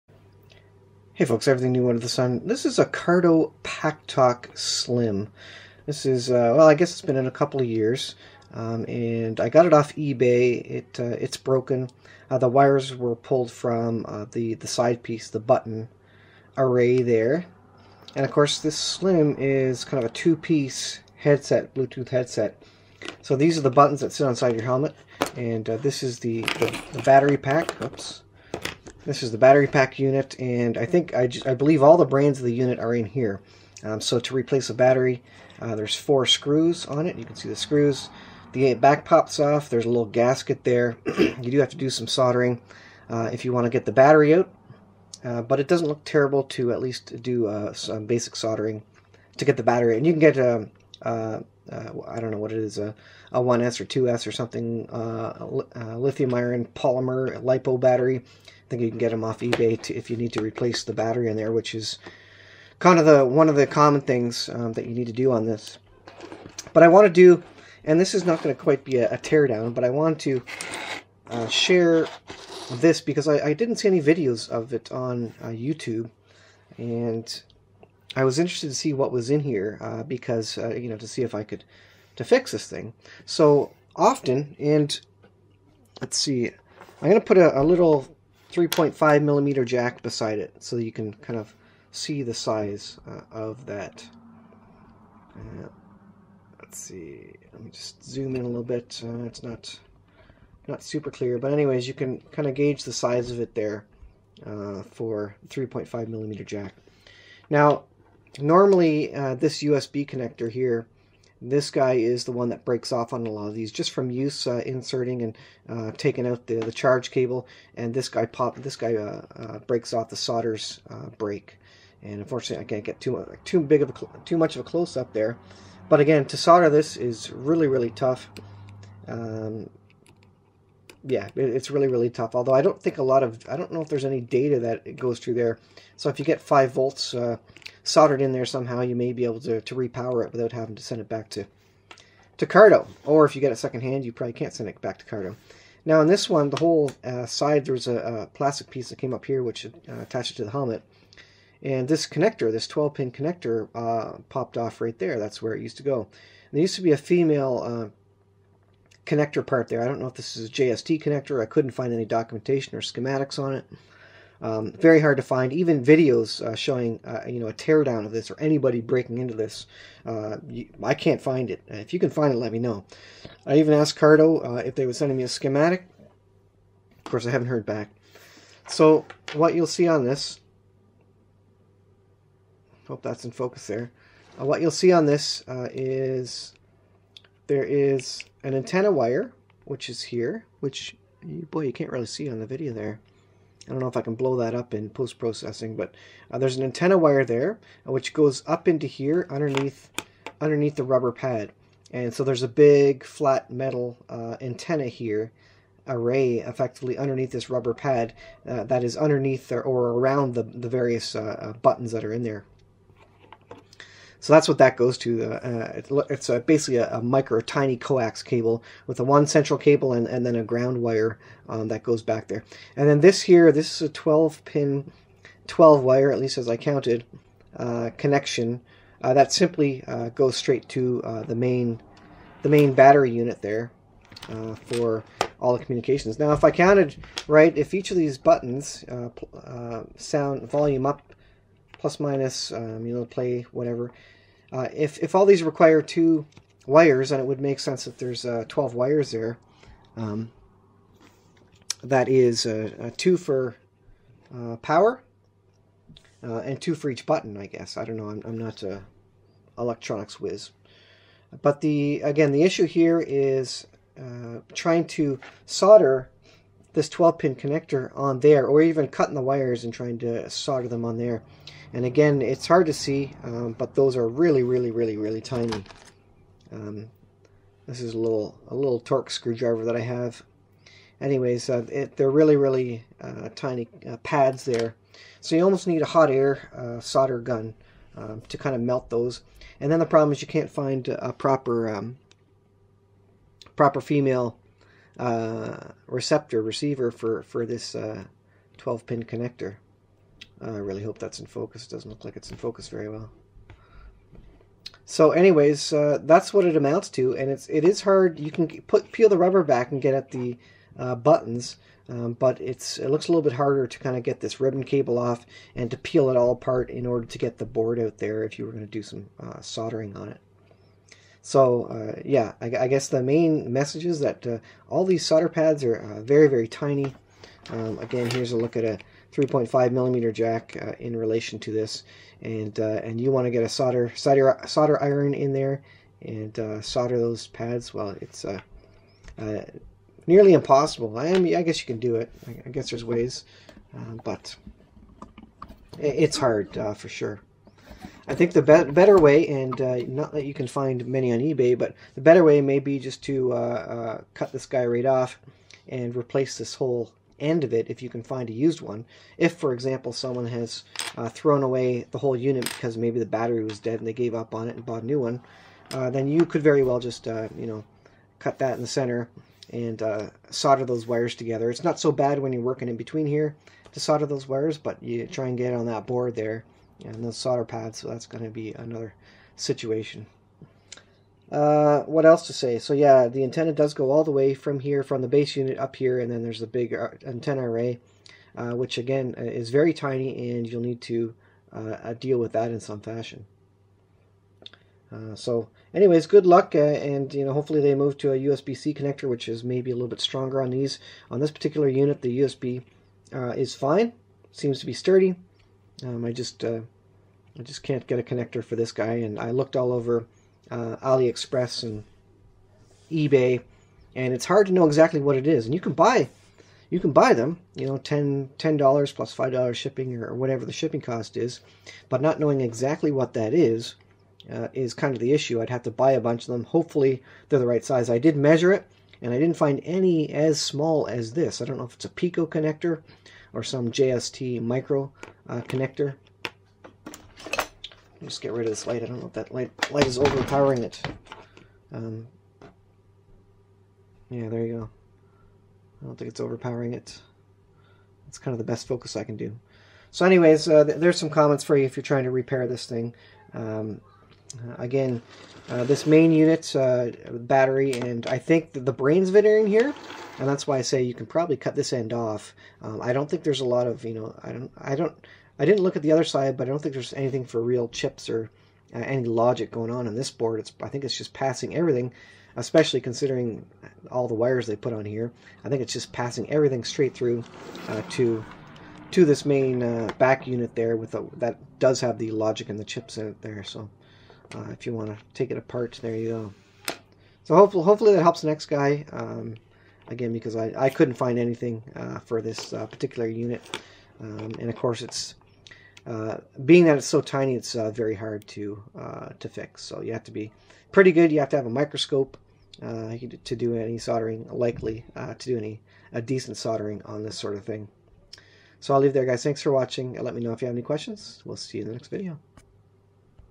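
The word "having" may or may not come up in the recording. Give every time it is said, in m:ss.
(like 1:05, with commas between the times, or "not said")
2:20.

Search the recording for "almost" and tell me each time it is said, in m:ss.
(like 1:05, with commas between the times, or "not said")
4:45.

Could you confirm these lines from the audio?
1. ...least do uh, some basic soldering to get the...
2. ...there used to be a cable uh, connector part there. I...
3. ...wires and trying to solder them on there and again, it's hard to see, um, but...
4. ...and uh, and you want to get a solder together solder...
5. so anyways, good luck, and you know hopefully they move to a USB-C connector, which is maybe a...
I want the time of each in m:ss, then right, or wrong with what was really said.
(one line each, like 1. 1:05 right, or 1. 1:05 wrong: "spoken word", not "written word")
1. 0:46 right
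2. 2:36 wrong: "female", not "cable"
3. 4:29 right
4. 5:32 wrong: "solder", not "together"
5. 6:35 right.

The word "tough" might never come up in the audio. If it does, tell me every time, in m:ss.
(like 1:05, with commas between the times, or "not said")
2:07, 2:12.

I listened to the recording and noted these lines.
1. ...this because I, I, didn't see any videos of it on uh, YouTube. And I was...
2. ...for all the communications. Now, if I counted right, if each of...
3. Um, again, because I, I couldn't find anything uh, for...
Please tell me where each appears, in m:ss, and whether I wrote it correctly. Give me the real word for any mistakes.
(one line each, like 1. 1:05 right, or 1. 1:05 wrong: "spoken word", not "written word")
1. 1:12 right
2. 3:54 right
3. 8:08 right.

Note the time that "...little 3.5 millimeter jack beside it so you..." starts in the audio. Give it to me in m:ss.
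1:27.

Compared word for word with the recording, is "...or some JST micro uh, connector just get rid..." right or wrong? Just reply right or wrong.
right.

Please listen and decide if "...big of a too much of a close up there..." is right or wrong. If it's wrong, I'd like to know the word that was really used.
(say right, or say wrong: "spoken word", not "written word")
right.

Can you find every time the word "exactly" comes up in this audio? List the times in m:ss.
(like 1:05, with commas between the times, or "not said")
6:54, 7:02.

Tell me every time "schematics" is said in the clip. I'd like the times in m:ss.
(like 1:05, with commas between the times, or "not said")
2:42, 2:55.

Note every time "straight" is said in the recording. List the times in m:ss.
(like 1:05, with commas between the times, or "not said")
3:50, 7:56.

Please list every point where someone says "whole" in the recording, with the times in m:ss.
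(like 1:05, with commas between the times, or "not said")
2:26, 5:56, 6:01.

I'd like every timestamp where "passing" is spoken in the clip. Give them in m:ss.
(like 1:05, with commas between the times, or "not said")
7:51, 7:55.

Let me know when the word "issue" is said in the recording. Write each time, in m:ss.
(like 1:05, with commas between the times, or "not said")
4:22, 7:05.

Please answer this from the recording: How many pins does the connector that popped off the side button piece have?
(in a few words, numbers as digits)
12.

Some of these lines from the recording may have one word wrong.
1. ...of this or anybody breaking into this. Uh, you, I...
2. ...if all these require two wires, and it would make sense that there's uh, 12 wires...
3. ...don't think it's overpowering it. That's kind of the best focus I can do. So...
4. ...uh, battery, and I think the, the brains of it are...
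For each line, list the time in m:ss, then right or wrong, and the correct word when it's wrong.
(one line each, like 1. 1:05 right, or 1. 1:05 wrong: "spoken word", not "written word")
1. 2:48 right
2. 4:04 right
3. 7:25 right
4. 7:36 right.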